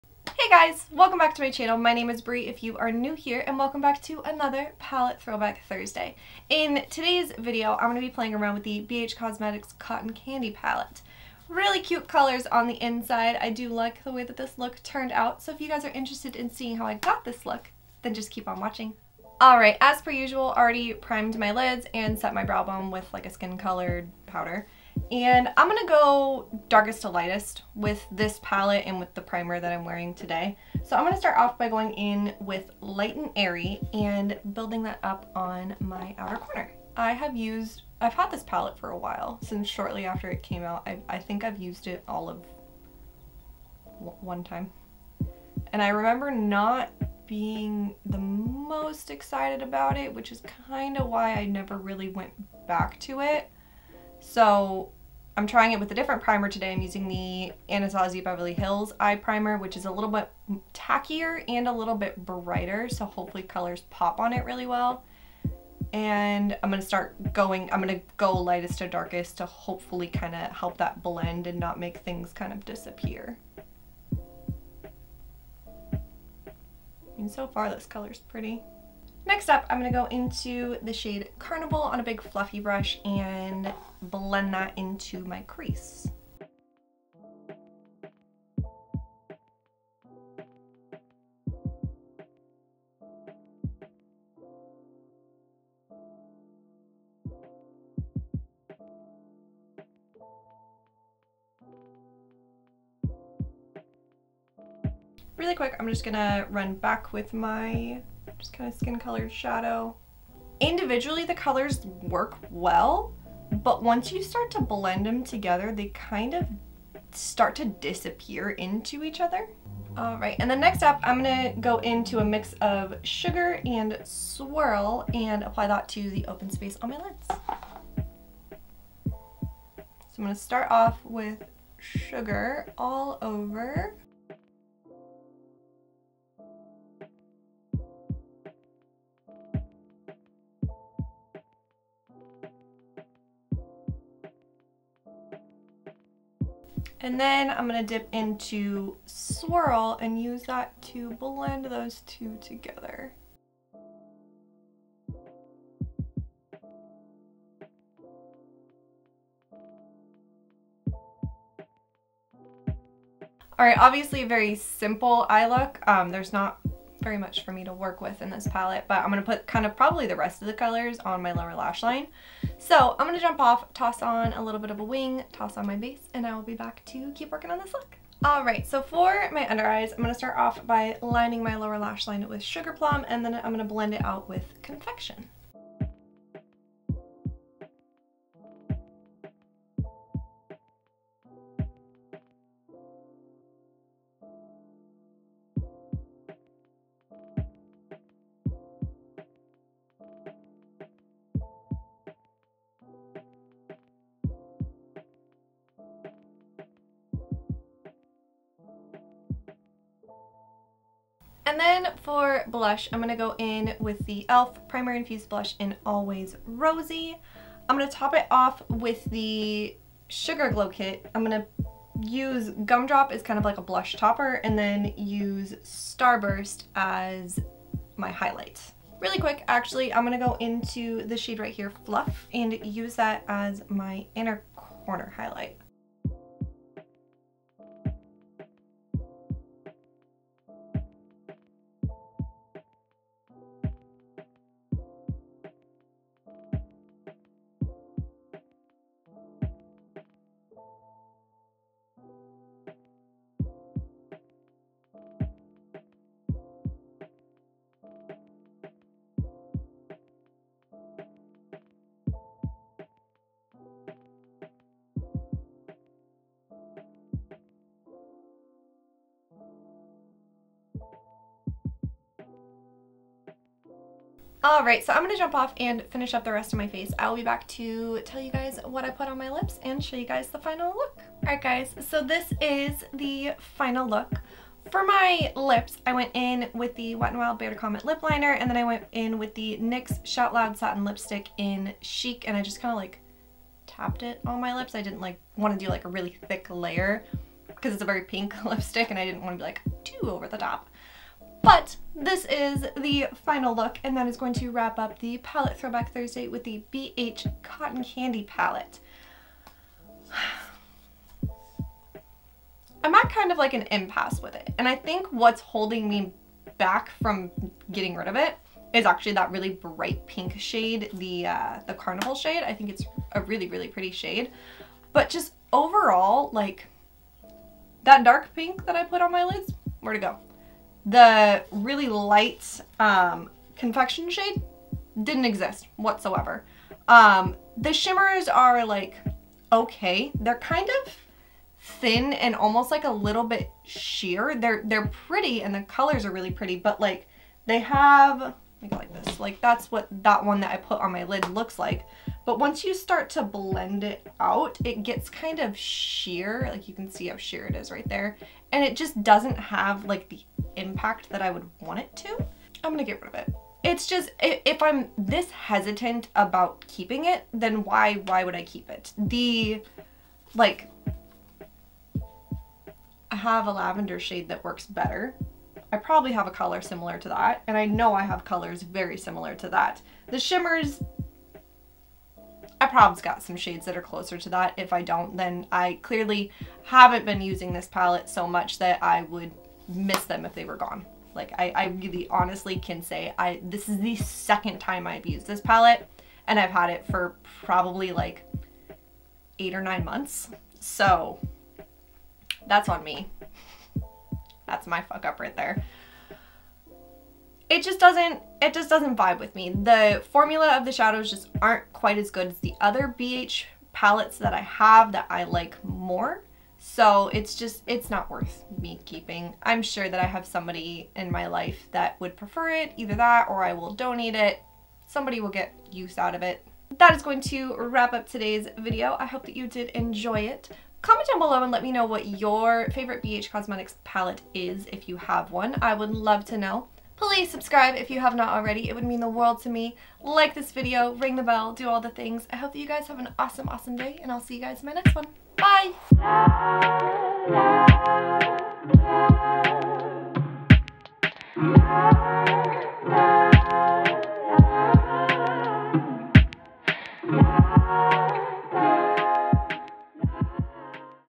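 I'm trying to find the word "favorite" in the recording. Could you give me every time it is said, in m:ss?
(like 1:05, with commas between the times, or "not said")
7:12.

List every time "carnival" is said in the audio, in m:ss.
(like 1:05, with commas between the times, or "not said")
1:21, 5:21.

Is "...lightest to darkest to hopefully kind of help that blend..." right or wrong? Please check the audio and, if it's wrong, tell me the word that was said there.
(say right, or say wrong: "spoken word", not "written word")
right.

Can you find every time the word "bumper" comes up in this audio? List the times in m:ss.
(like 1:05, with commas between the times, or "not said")
not said.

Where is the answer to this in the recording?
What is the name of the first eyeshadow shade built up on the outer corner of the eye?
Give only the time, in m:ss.
0:32.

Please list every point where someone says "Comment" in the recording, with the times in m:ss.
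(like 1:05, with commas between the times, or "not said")
4:47, 7:10.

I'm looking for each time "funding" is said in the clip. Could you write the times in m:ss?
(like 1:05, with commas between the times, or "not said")
not said.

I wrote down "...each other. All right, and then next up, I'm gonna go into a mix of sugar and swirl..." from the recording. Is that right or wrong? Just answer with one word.
right.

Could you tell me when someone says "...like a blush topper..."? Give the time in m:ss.
3:43.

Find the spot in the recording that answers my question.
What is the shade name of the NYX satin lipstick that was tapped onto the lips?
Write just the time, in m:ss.
4:51.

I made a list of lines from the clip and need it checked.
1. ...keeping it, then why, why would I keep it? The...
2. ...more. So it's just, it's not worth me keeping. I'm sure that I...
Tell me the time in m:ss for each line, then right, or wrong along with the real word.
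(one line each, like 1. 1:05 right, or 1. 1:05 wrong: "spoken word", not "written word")
1. 6:06 right
2. 6:55 right.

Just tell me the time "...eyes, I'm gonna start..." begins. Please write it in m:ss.
2:59.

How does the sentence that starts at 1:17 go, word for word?
And so far this color's pretty.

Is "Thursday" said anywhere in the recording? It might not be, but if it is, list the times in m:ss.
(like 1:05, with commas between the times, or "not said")
0:05, 5:05.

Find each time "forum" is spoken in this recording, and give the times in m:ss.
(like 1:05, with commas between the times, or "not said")
not said.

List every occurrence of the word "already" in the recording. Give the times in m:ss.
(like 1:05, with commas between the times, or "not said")
0:20, 7:18.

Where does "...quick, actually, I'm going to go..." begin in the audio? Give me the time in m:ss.
3:49.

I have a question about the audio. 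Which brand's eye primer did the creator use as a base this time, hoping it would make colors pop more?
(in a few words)
Anastasia Beverly Hills.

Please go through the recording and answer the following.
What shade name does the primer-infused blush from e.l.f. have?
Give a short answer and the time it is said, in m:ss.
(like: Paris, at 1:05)
Always Rosy, at 3:35.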